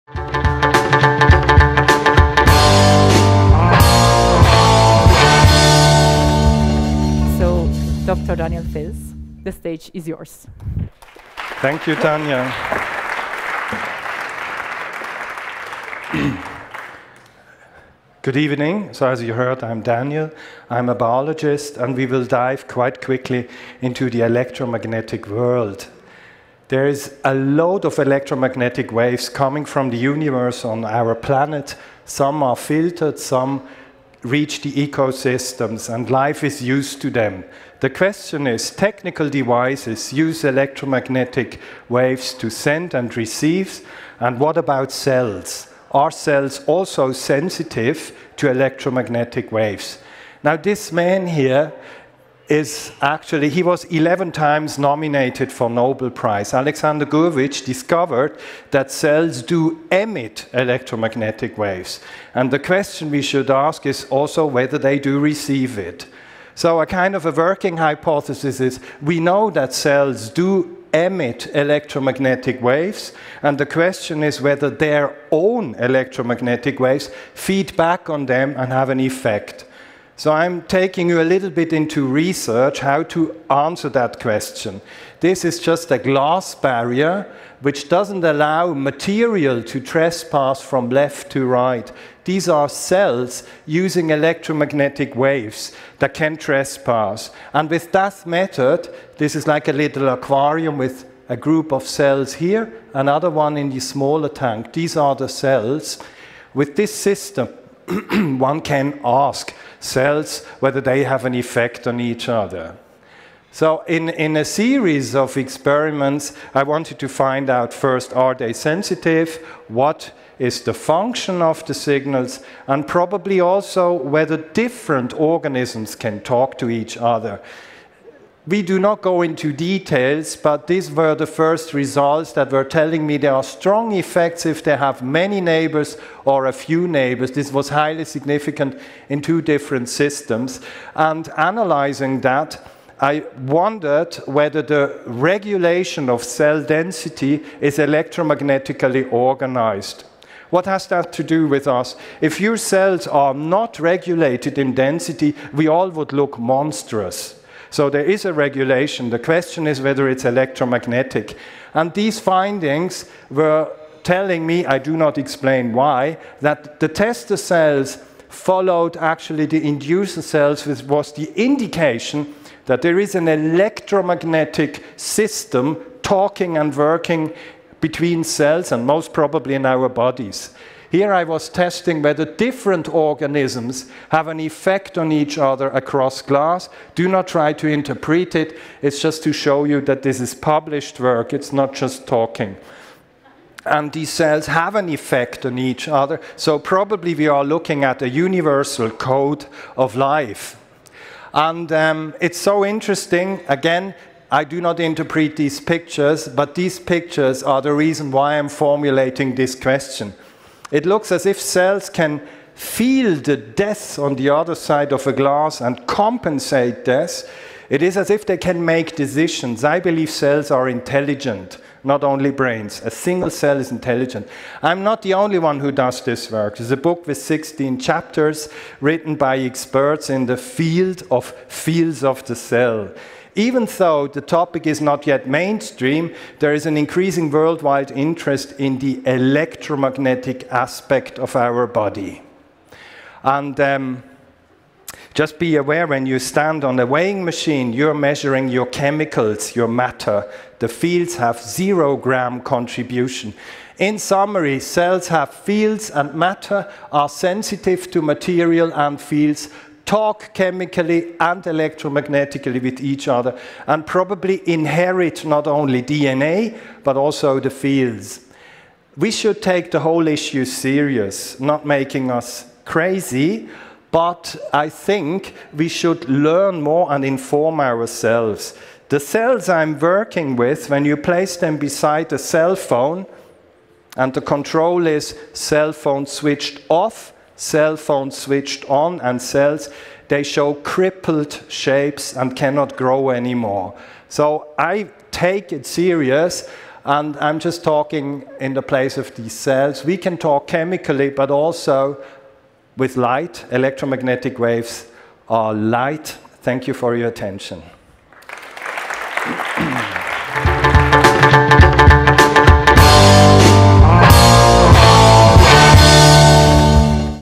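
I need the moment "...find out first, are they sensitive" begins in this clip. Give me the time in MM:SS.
01:57.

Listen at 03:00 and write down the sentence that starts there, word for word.
Here I was testing whether different organisms have an effect on each other across glass.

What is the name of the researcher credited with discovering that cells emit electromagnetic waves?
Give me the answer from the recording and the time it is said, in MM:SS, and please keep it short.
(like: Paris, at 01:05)
Alexander Gurevich, at 00:56.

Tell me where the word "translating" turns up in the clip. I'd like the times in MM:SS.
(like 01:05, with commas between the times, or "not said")
not said.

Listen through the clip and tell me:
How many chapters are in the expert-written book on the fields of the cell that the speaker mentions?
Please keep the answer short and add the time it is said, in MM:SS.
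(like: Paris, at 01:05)
16, at 03:47.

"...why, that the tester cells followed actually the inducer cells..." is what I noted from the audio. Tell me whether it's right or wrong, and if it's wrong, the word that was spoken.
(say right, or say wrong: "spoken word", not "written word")
right.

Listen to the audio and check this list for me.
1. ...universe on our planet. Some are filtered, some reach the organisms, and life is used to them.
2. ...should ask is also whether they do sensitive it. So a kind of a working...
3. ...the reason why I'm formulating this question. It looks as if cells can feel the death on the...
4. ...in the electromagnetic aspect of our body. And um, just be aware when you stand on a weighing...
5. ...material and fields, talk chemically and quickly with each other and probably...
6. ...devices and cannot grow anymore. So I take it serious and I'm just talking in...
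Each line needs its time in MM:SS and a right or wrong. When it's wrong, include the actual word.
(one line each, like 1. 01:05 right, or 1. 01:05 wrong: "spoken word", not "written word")
1. 00:29 wrong: "ecosystems", not "organisms"
2. 01:03 wrong: "receive", not "sensitive"
3. 03:27 right
4. 03:58 right
5. 04:18 wrong: "electromagnetically", not "quickly"
6. 04:51 wrong: "shapes", not "devices".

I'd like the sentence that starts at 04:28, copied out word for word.
We should take the whole issue serious, not making us crazy, but I think we should learn more and inform ourselves.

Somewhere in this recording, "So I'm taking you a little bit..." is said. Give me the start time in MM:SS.
01:20.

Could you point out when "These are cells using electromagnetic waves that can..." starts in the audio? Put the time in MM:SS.
01:32.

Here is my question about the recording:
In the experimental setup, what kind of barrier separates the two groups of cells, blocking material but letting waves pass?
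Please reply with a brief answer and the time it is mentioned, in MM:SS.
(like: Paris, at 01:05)
glass barrier, at 01:25.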